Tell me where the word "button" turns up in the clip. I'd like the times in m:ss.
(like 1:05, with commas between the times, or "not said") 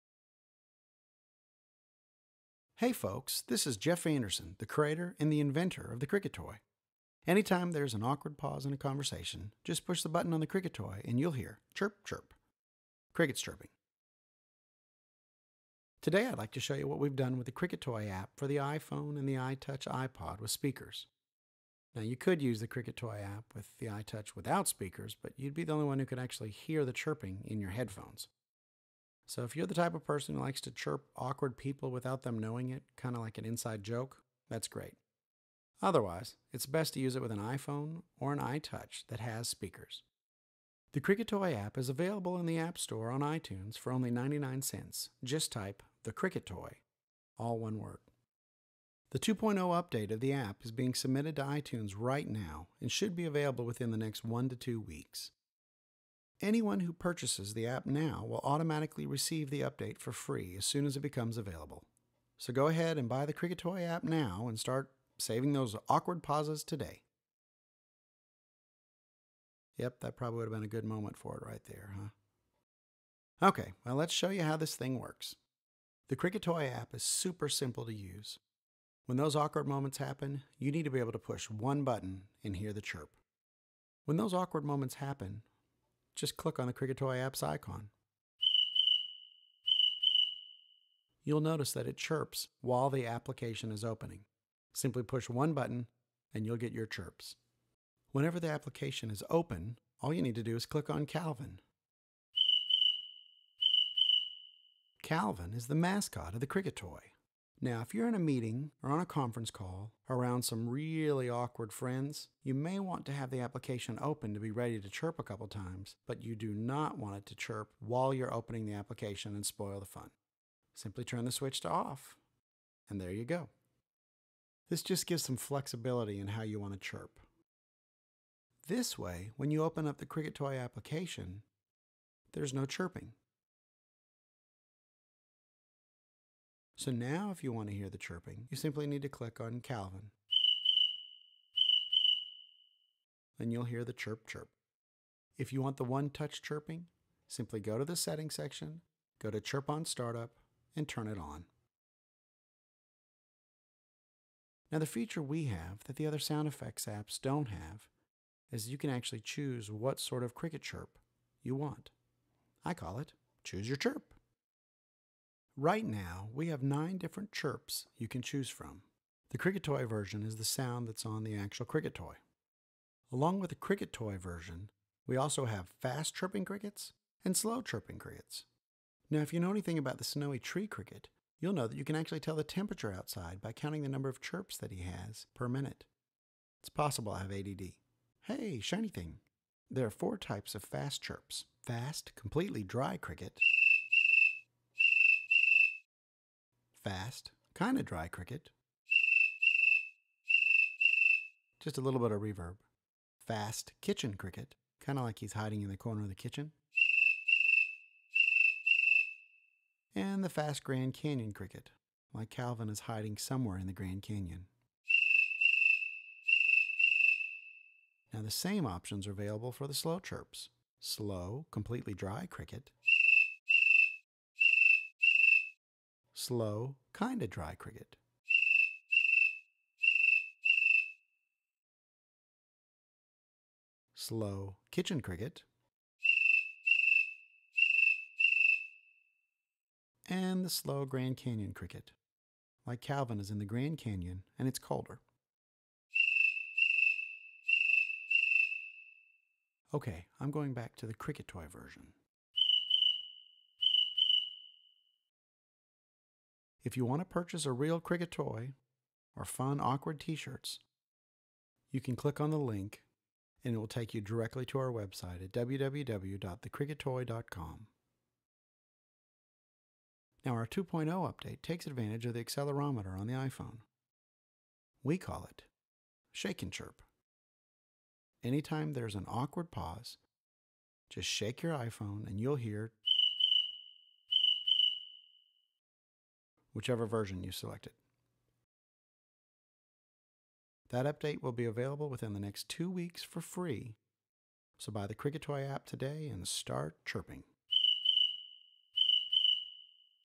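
0:10, 1:21, 1:35.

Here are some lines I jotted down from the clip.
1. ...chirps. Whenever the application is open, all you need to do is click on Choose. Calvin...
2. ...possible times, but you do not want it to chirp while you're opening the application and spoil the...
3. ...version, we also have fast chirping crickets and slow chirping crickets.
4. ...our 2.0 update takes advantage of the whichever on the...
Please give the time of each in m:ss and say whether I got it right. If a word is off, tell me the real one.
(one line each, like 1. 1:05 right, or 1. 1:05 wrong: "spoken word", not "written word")
1. 1:36 wrong: "Calvin", not "Choose"
2. 1:55 wrong: "couple", not "possible"
3. 2:54 right
4. 4:30 wrong: "accelerometer", not "whichever".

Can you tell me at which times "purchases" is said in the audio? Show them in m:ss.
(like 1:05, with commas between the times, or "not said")
0:56, 4:17.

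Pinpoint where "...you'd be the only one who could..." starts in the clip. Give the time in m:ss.
0:25.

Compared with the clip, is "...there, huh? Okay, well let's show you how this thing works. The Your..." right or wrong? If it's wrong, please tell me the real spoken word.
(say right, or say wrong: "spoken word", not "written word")
wrong: "Cricket", not "Your".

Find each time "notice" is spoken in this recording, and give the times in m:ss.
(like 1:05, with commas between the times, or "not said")
1:31.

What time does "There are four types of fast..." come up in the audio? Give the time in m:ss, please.
3:09.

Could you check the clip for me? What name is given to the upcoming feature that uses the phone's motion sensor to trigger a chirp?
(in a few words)
Shake and Chirp.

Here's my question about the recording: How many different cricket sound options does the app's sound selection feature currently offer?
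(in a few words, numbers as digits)
9.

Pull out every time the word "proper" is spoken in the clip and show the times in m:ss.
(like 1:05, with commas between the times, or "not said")
not said.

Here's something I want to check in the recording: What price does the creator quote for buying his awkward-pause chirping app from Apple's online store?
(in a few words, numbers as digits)
99 cents.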